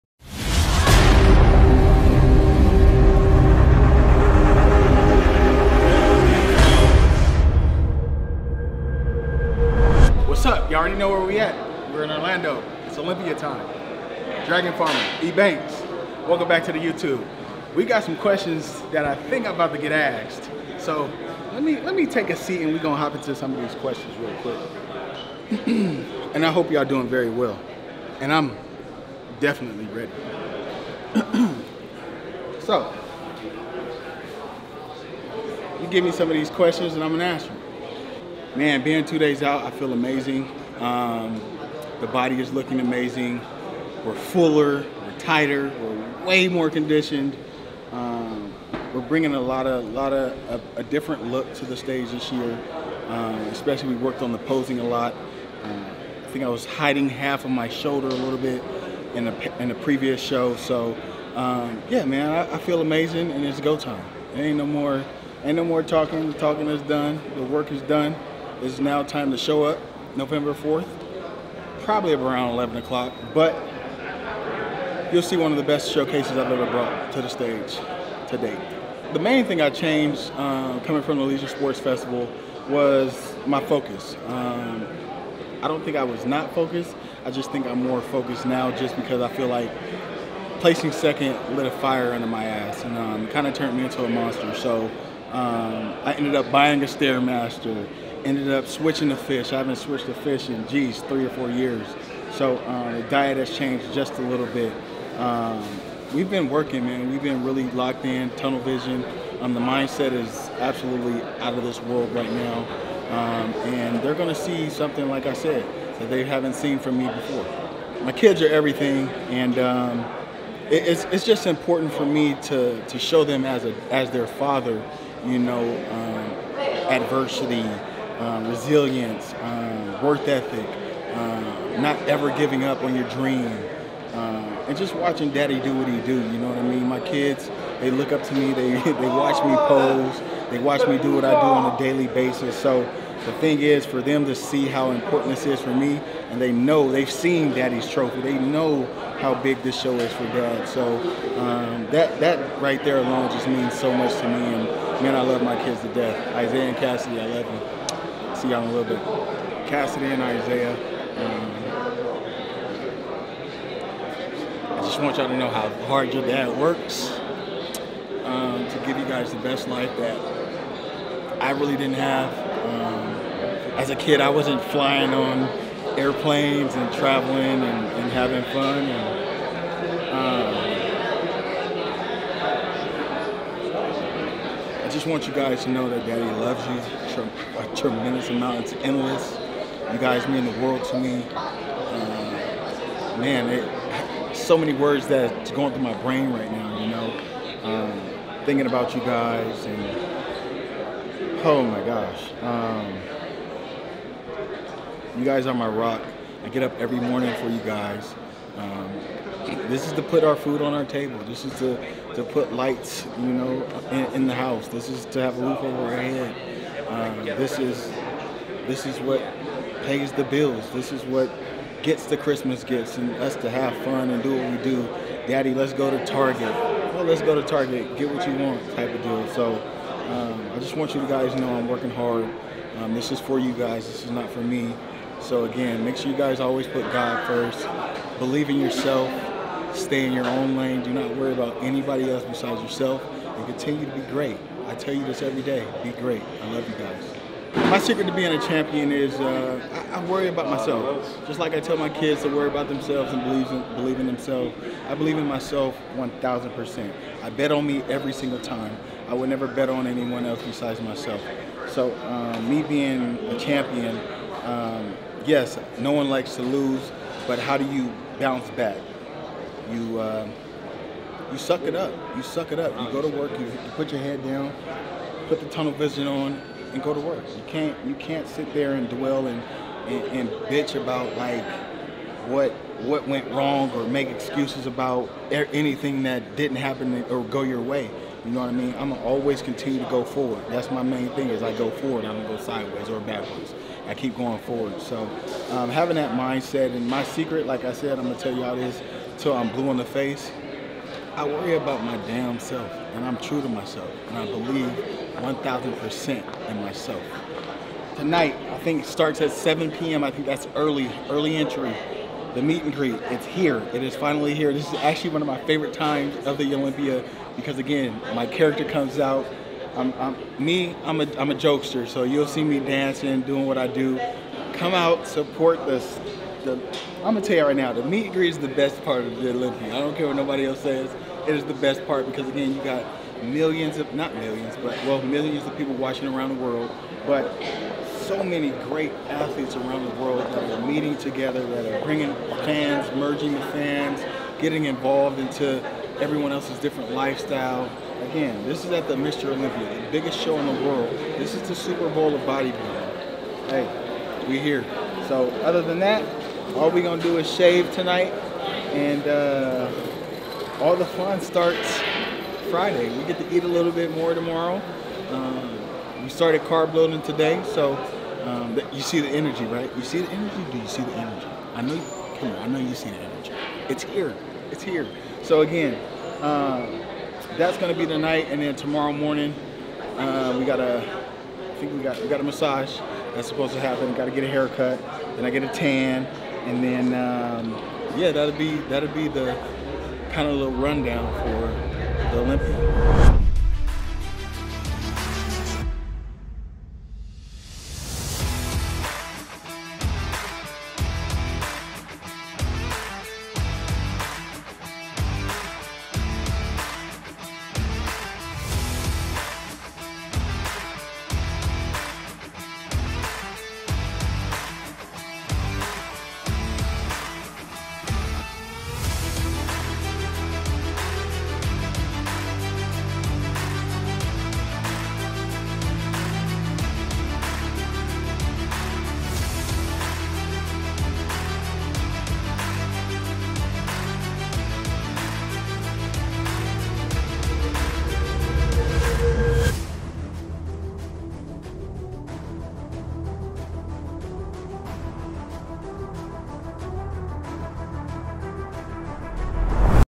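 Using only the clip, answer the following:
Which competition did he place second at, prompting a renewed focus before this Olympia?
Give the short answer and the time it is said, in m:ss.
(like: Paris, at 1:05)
Legion Sports Festival, at 1:21.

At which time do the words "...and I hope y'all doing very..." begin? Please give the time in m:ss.
0:26.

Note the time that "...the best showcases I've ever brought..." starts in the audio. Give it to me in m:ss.
1:15.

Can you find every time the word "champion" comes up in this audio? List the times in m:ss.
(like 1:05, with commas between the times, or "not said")
4:08, 4:23.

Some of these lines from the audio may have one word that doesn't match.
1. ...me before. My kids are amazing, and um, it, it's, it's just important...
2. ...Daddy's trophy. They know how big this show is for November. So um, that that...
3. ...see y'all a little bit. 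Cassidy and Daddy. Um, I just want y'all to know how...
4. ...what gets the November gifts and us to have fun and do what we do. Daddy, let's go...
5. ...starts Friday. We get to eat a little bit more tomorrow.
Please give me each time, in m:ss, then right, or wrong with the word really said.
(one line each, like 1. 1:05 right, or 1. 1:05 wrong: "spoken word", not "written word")
1. 1:56 wrong: "everything", not "amazing"
2. 2:27 wrong: "Dad", not "November"
3. 2:38 wrong: "Isaiah", not "Daddy"
4. 3:41 wrong: "Christmas", not "November"
5. 6:01 right.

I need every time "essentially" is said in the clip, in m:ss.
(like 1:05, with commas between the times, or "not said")
not said.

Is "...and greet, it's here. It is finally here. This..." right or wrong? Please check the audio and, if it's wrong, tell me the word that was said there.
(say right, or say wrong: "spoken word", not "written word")
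right.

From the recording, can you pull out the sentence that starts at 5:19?
I'm, I'm me, I'm a, I'm a jokester, so you'll see me dancing, doing what I do.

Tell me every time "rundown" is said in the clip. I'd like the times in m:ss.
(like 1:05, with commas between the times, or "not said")
6:30.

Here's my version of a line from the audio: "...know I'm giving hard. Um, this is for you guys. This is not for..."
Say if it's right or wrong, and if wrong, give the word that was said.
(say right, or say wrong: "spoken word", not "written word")
wrong: "working", not "giving".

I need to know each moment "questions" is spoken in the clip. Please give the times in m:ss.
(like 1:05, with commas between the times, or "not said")
0:18, 0:23, 0:36.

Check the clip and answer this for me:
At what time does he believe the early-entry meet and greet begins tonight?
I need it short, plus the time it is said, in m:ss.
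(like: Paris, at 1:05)
7 p.m., at 5:09.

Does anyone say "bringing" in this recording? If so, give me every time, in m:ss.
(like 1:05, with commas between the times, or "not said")
0:49, 5:41.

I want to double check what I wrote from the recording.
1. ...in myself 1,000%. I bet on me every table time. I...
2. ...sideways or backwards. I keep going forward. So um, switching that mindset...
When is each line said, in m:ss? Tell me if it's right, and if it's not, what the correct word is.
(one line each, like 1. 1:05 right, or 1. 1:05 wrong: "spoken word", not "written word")
1. 4:15 wrong: "single", not "table"
2. 4:52 wrong: "having", not "switching".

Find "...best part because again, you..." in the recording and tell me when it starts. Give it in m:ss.
5:31.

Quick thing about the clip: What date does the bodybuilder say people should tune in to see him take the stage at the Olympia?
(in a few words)
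November 4th.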